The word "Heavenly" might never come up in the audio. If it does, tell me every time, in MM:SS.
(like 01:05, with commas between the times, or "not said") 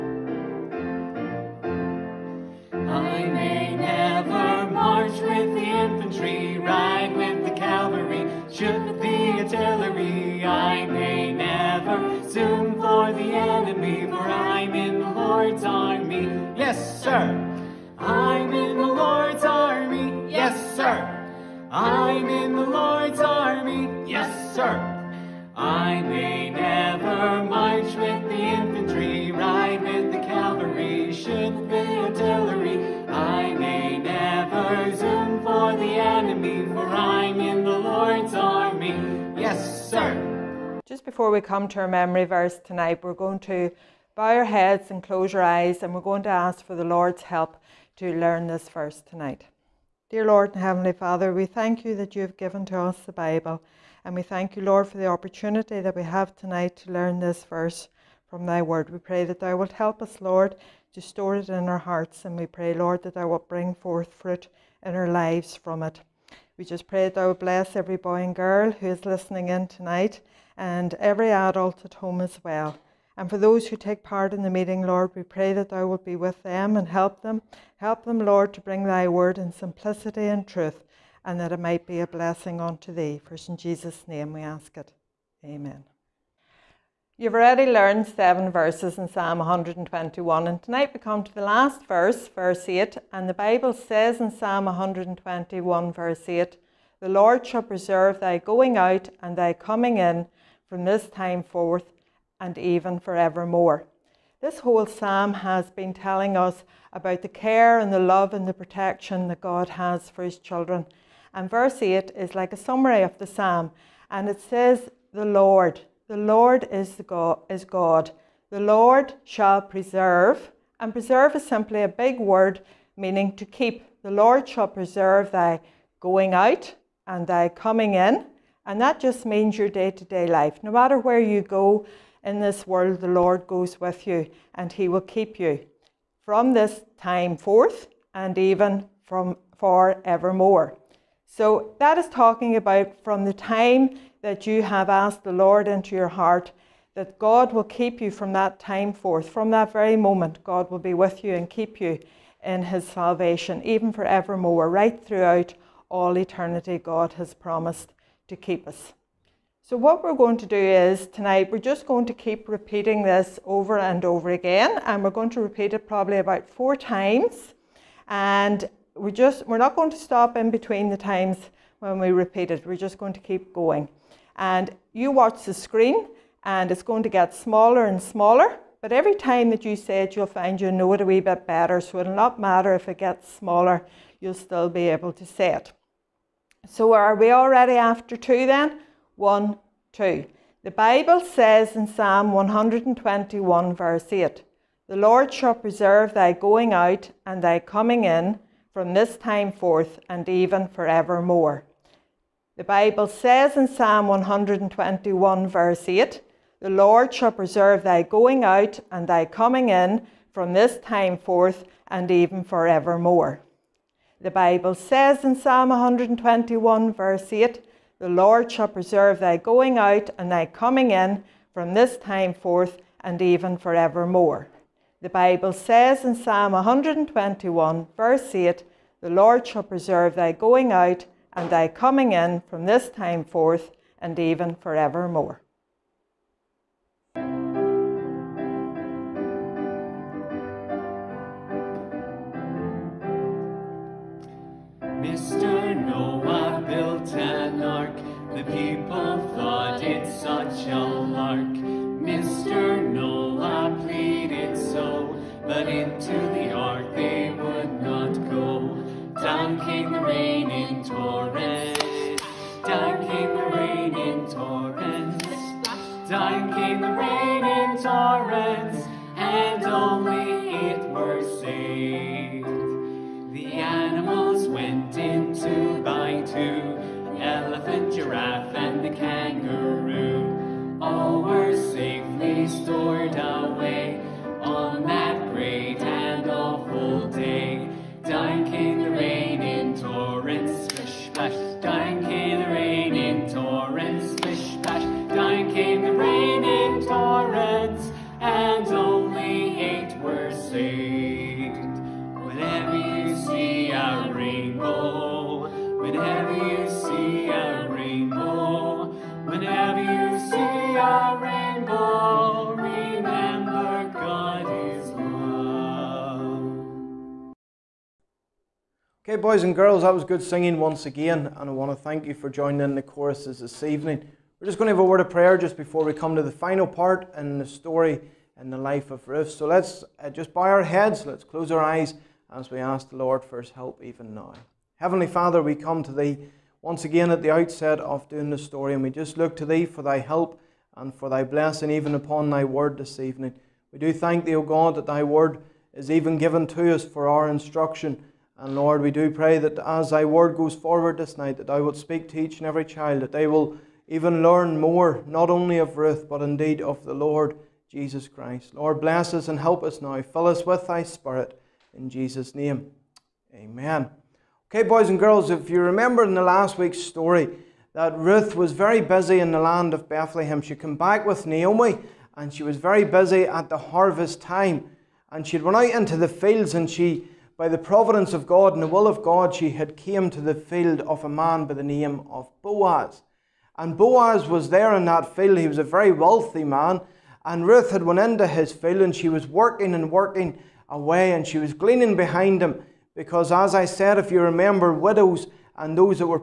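00:50, 05:34.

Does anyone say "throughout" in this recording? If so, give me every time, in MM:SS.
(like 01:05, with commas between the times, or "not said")
02:35.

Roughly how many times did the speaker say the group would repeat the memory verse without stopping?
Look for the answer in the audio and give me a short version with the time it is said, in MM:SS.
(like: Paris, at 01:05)
4, at 02:46.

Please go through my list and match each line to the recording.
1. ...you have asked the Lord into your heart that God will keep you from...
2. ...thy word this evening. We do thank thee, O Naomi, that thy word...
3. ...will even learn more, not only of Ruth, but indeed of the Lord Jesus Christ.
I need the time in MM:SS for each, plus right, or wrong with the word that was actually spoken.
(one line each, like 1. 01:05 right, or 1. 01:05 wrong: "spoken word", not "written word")
1. 02:24 right
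2. 05:42 wrong: "God", not "Naomi"
3. 05:53 right.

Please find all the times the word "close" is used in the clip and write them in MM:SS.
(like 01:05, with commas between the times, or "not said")
00:45, 05:31.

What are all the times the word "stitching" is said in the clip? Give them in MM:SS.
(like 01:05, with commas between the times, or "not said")
not said.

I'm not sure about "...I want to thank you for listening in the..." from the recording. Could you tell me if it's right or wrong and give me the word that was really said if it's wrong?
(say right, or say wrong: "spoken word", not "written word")
wrong: "joining", not "listening".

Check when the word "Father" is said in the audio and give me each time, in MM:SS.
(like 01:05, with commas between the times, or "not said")
00:50, 05:35.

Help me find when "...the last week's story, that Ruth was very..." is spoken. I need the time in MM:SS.
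06:06.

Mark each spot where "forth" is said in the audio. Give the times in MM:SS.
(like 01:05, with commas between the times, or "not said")
01:03, 01:41, 02:17, 02:28, 03:19, 03:31, 03:42, 03:53.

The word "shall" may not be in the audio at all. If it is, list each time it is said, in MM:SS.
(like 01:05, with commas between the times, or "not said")
01:37, 01:59, 02:04, 03:15, 03:27, 03:38, 03:49.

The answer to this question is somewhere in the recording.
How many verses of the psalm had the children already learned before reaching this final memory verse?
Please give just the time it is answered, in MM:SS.
01:28.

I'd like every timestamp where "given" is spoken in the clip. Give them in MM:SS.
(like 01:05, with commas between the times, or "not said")
00:52, 05:46.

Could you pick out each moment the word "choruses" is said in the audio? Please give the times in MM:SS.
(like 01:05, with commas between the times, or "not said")
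05:22.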